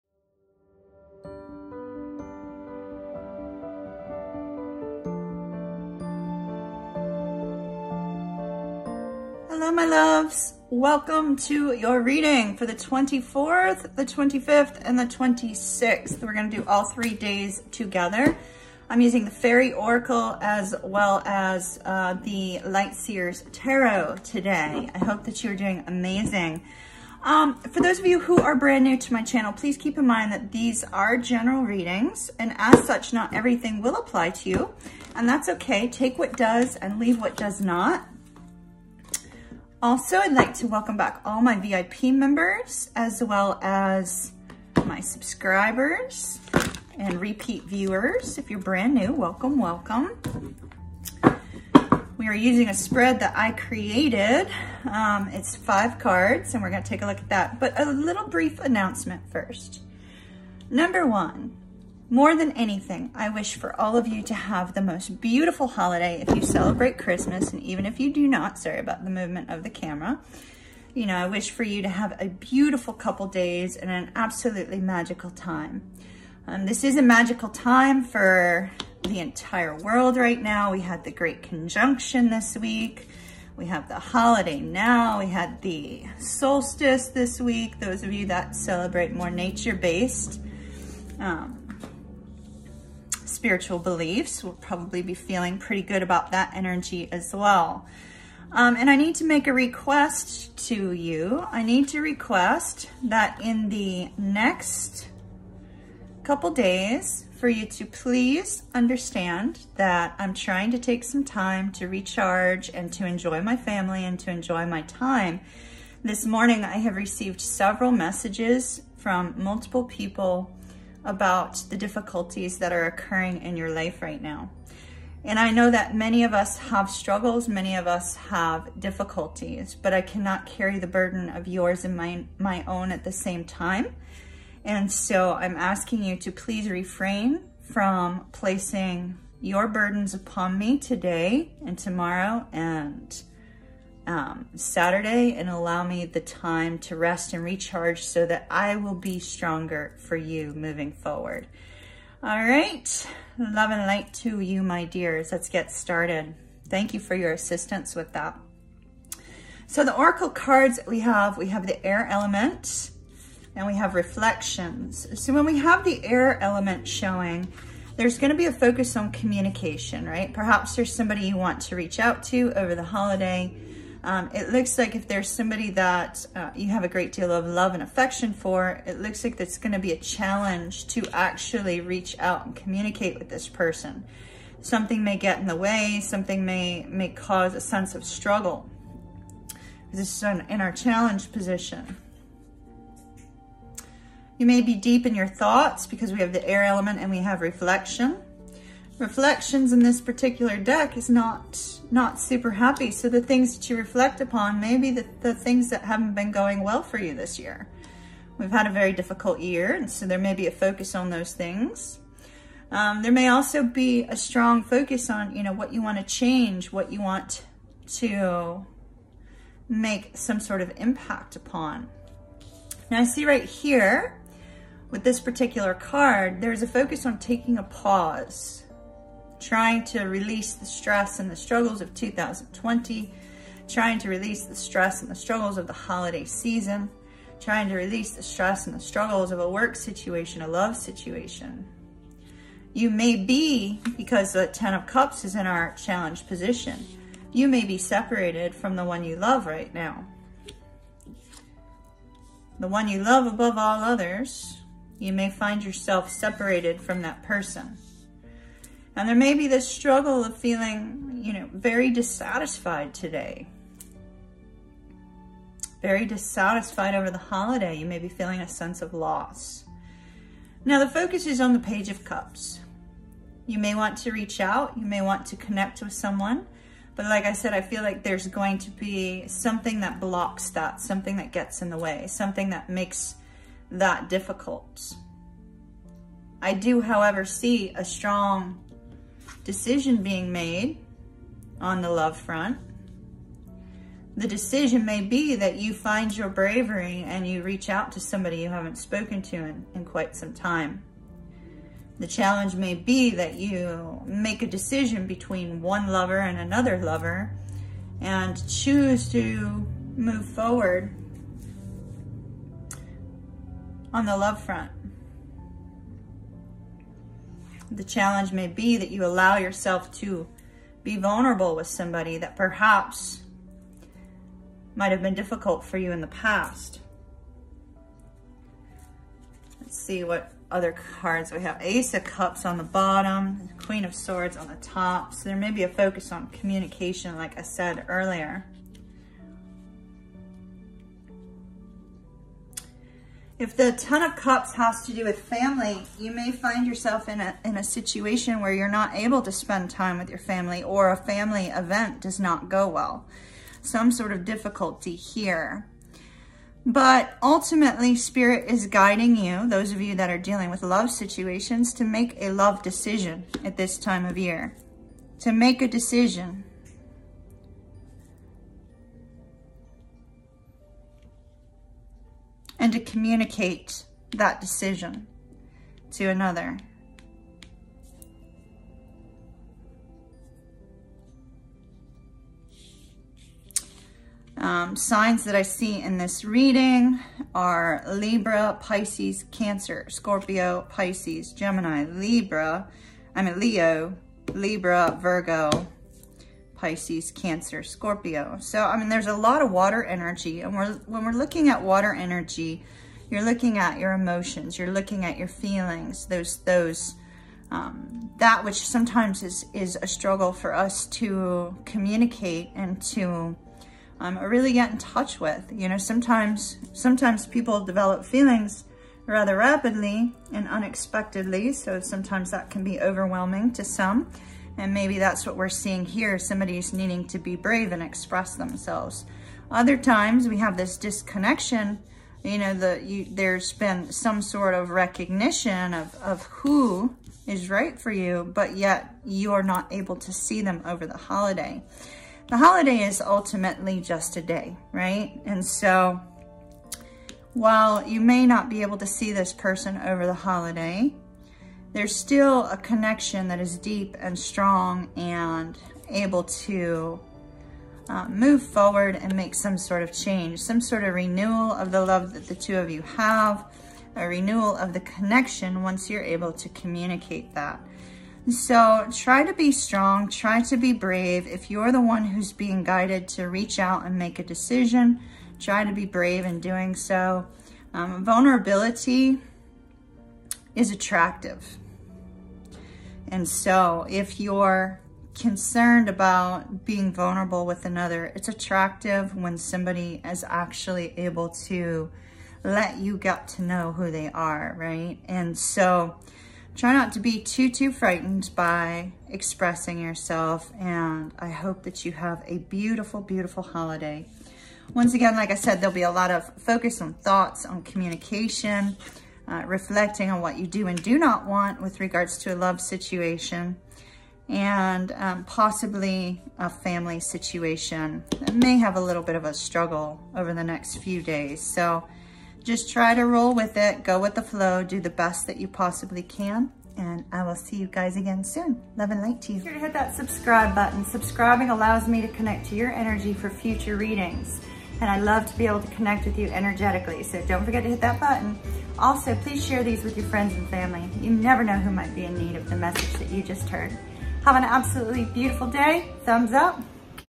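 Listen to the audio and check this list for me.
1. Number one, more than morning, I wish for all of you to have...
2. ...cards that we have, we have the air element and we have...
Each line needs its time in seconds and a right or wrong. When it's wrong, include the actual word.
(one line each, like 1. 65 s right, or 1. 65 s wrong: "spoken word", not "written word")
1. 60 s wrong: "anything", not "morning"
2. 160 s right.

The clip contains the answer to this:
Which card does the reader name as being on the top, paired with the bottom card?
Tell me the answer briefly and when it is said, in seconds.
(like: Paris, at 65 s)
Queen of Swords, at 333 s.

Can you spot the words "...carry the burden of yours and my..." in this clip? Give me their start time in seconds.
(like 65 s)
130 s.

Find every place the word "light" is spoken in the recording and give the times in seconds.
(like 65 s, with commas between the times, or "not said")
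22 s, 153 s, 529 s.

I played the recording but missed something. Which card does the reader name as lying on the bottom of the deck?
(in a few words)
Ace of Cups.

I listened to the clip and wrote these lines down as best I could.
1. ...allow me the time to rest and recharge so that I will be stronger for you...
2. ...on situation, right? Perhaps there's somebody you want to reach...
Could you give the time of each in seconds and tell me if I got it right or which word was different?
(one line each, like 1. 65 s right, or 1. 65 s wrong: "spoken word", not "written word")
1. 145 s right
2. 168 s wrong: "communication", not "situation".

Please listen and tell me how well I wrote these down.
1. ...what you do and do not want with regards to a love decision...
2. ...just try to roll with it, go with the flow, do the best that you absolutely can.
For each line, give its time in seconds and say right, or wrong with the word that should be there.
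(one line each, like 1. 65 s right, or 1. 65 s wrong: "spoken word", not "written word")
1. 510 s wrong: "situation", not "decision"
2. 522 s wrong: "possibly", not "absolutely".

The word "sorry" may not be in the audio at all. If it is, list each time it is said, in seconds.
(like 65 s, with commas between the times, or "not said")
68 s.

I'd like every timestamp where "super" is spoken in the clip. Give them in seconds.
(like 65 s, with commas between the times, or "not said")
202 s.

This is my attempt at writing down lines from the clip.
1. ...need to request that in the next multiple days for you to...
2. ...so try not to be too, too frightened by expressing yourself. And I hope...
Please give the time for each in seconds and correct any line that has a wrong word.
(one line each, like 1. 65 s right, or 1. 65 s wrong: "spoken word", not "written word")
1. 101 s wrong: "couple", not "multiple"
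2. 495 s right.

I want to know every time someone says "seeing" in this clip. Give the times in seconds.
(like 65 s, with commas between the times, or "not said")
425 s.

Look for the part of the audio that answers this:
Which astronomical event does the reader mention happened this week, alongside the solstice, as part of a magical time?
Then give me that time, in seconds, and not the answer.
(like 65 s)
81 s.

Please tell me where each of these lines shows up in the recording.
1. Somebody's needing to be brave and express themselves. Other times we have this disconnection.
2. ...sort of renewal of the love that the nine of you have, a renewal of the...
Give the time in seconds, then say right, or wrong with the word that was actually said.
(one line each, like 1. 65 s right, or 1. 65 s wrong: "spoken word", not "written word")
1. 426 s right
2. 460 s wrong: "two", not "nine".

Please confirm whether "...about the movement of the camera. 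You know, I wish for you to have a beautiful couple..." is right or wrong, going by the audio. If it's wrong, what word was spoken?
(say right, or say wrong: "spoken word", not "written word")
right.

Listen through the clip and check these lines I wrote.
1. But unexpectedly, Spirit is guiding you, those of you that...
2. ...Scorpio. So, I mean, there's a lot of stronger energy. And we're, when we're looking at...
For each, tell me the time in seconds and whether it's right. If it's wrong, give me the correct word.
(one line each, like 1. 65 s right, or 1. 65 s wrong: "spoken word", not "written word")
1. 356 s wrong: "ultimately", not "unexpectedly"
2. 397 s wrong: "water", not "stronger".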